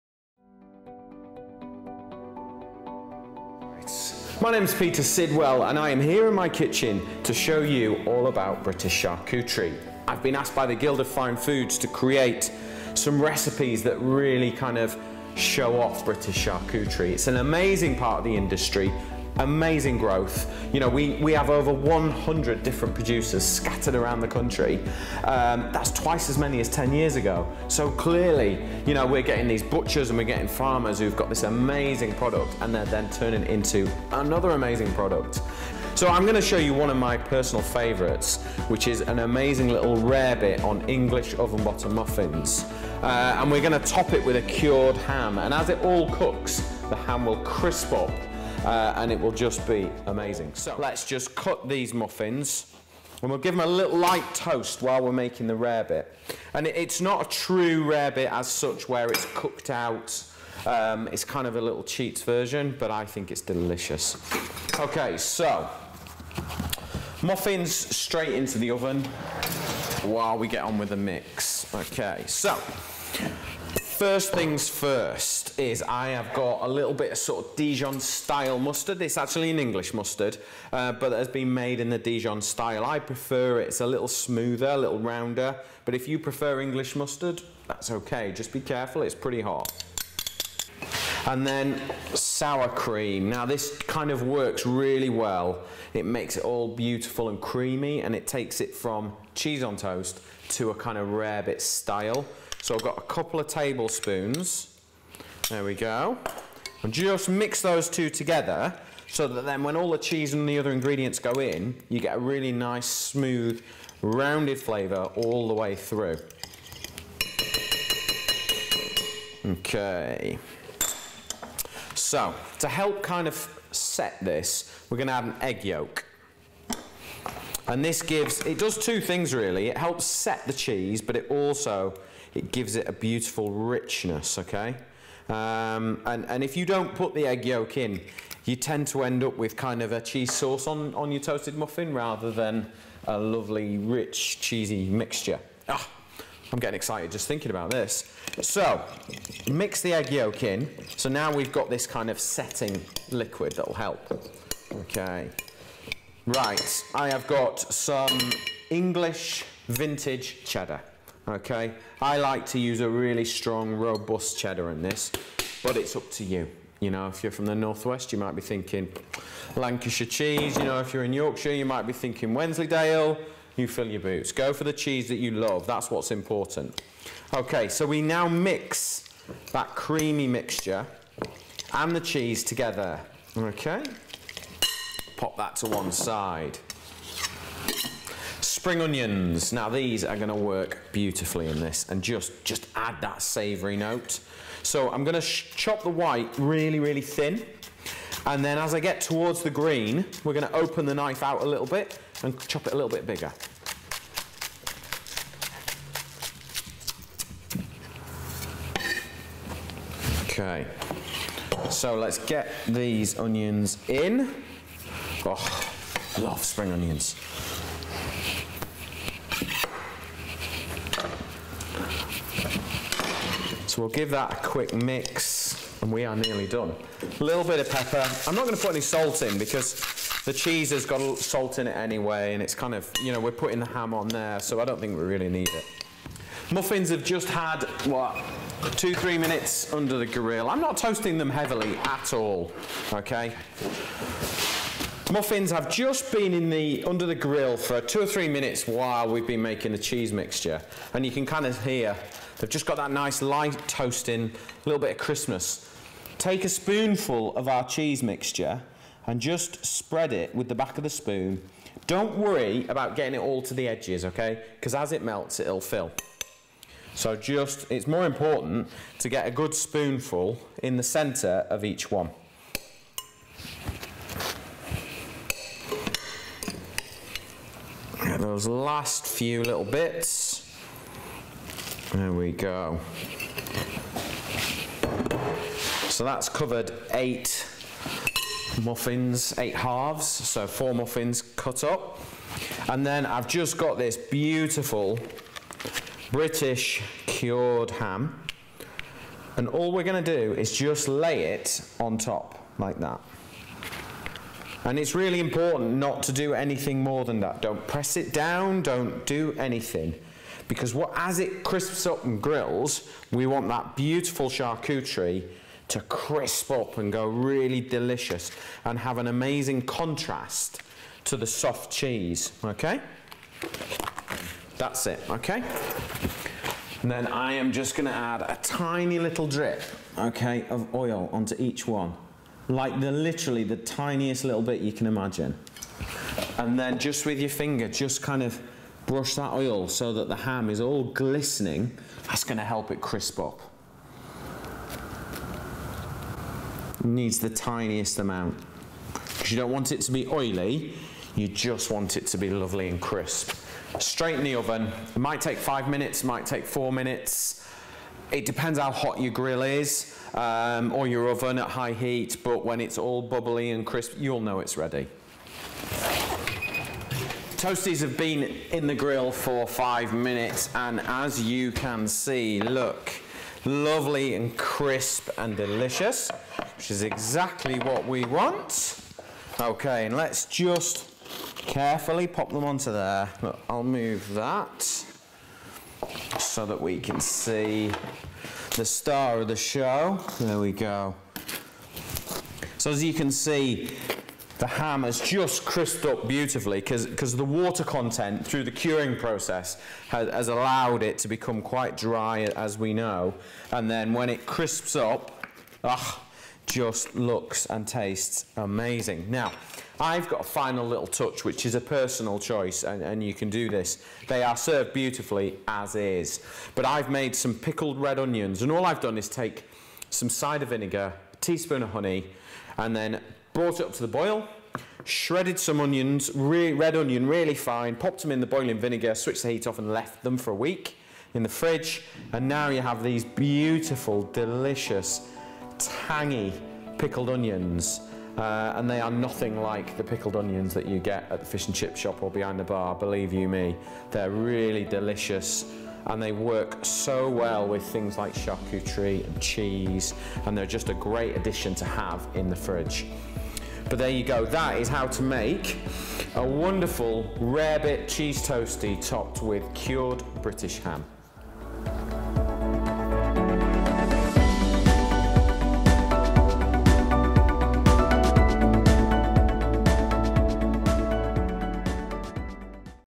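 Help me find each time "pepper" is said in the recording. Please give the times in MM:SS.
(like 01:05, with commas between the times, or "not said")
03:47.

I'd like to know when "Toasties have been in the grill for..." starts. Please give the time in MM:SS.
06:07.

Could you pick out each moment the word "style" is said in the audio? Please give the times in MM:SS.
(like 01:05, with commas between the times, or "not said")
01:17, 01:22, 01:41.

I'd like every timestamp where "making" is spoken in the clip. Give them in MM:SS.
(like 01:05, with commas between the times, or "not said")
00:55, 04:09.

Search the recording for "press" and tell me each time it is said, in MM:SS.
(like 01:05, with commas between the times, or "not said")
05:07.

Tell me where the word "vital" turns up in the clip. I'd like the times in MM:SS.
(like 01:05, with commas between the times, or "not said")
not said.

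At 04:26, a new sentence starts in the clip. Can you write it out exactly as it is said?
So just, it's more important to get a good spoonful in the center of each one.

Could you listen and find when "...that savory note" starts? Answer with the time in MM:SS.
03:13.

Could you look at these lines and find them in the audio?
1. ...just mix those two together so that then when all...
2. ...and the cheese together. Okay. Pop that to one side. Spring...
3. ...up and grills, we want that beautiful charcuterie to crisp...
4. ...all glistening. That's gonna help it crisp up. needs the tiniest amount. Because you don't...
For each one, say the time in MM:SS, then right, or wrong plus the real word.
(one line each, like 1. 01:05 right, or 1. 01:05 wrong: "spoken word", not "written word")
1. 01:46 right
2. 03:01 right
3. 05:11 right
4. 05:40 right.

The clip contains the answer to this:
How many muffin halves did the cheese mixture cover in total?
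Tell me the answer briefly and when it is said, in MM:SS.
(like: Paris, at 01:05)
8, at 04:49.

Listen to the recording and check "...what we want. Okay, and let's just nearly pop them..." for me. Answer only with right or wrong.
wrong.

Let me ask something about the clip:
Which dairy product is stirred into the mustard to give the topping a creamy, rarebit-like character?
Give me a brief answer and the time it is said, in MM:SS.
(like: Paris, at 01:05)
sour cream, at 01:32.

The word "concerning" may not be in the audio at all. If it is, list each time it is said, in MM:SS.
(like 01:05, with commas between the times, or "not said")
not said.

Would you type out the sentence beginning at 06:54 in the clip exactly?
They are served beautifully as is.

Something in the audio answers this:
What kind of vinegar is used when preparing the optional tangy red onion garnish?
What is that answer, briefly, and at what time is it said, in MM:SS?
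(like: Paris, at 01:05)
cider vinegar, at 07:00.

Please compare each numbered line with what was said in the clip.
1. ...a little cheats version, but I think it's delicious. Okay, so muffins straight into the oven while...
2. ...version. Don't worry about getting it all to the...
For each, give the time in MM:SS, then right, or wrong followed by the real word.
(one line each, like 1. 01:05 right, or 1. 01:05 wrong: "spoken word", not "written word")
1. 01:01 right
2. 04:20 wrong: "spoon", not "version".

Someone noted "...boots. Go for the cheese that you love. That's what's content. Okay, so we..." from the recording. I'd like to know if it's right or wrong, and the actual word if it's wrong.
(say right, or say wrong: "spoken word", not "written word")
wrong: "important", not "content".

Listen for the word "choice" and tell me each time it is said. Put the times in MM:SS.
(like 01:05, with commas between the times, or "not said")
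06:52.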